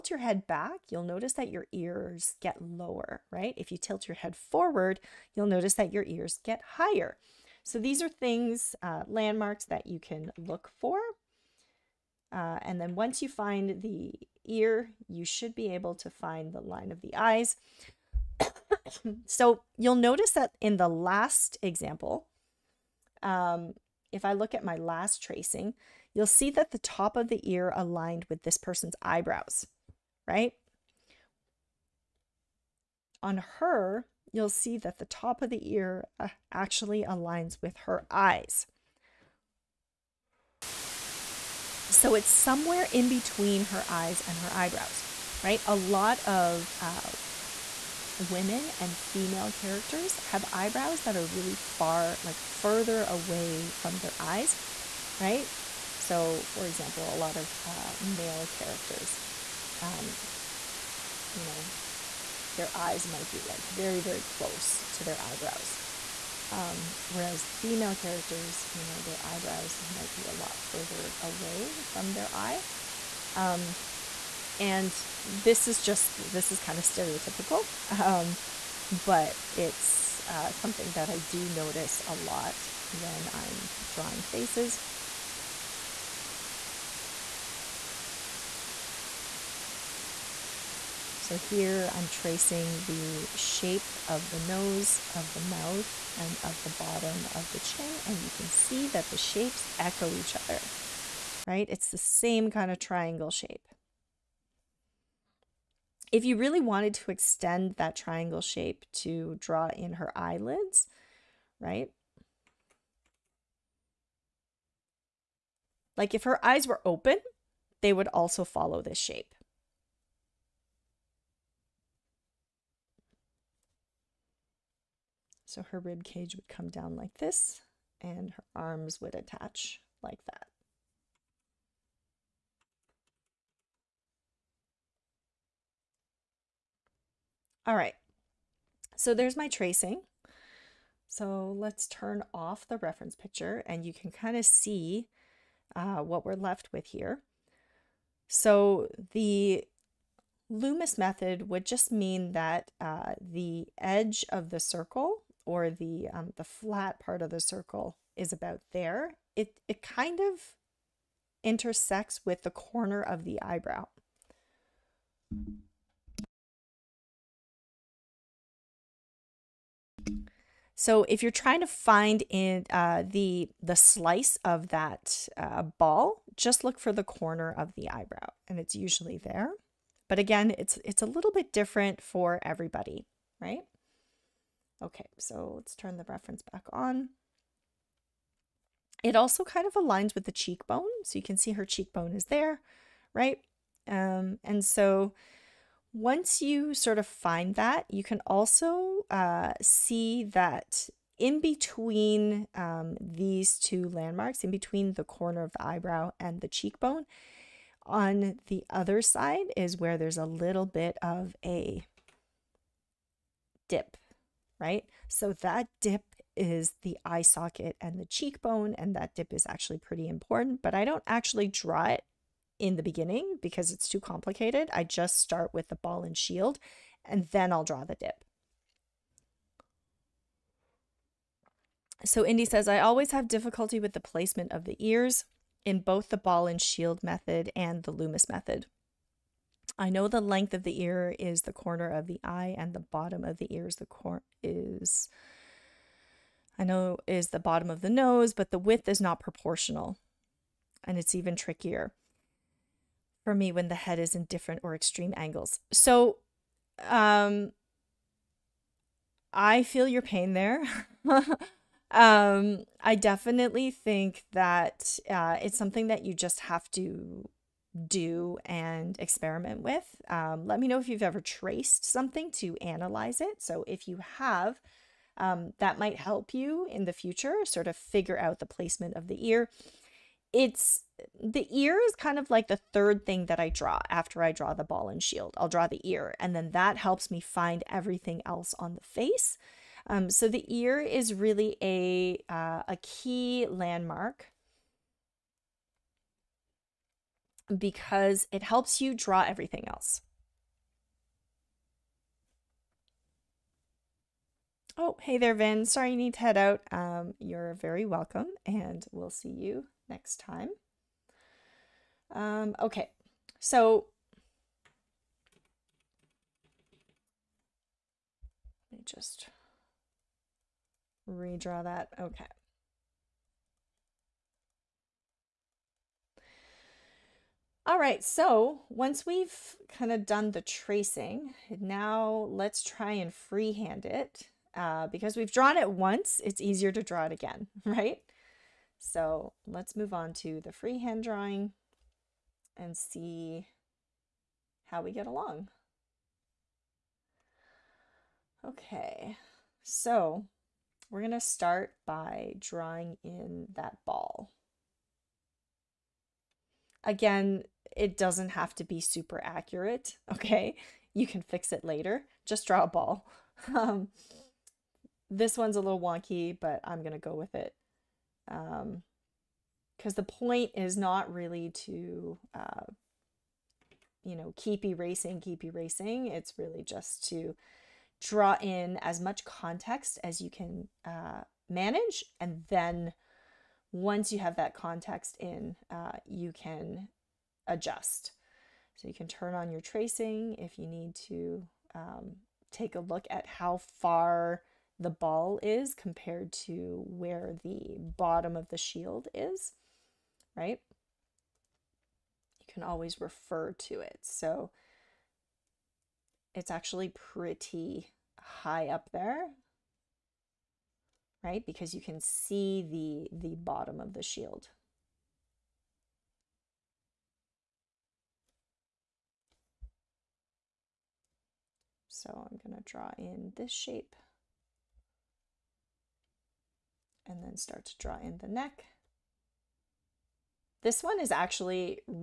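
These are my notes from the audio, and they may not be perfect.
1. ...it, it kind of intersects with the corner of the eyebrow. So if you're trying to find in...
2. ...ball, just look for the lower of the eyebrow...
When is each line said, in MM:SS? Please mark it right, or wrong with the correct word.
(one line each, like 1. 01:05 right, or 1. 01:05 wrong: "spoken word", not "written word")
1. 02:39 right
2. 02:55 wrong: "corner", not "lower".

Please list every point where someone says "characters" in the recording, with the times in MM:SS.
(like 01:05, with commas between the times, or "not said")
00:49, 00:58, 01:07.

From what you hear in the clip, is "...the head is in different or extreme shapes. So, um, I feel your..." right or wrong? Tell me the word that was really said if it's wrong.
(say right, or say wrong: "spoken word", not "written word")
wrong: "angles", not "shapes".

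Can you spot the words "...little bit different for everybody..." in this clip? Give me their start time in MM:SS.
03:01.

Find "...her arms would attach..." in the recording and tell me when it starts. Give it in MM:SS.
02:08.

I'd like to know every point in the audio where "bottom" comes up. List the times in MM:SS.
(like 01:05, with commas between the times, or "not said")
01:36, 04:02, 04:07, 06:37, 06:53.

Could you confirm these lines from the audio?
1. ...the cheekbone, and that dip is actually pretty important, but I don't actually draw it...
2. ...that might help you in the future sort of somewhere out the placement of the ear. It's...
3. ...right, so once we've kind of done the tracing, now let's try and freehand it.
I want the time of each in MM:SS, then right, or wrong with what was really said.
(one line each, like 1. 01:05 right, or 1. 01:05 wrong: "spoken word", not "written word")
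1. 03:37 right
2. 04:35 wrong: "figure", not "somewhere"
3. 05:27 right.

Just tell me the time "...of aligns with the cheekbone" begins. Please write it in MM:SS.
03:09.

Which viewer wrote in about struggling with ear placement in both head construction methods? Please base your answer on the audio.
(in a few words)
Indy.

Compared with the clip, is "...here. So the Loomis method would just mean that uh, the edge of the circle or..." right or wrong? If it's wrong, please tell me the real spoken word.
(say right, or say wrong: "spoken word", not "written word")
right.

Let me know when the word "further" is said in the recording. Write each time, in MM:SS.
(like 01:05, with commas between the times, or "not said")
00:52, 01:10.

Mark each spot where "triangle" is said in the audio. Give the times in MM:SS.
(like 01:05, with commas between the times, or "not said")
01:42, 01:47.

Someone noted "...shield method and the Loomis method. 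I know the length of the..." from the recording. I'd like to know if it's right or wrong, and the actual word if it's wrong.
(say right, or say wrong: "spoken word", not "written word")
right.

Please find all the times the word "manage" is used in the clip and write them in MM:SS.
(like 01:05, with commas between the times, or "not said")
06:21.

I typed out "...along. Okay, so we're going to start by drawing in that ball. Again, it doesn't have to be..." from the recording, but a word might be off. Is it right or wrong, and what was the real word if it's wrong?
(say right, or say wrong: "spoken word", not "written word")
right.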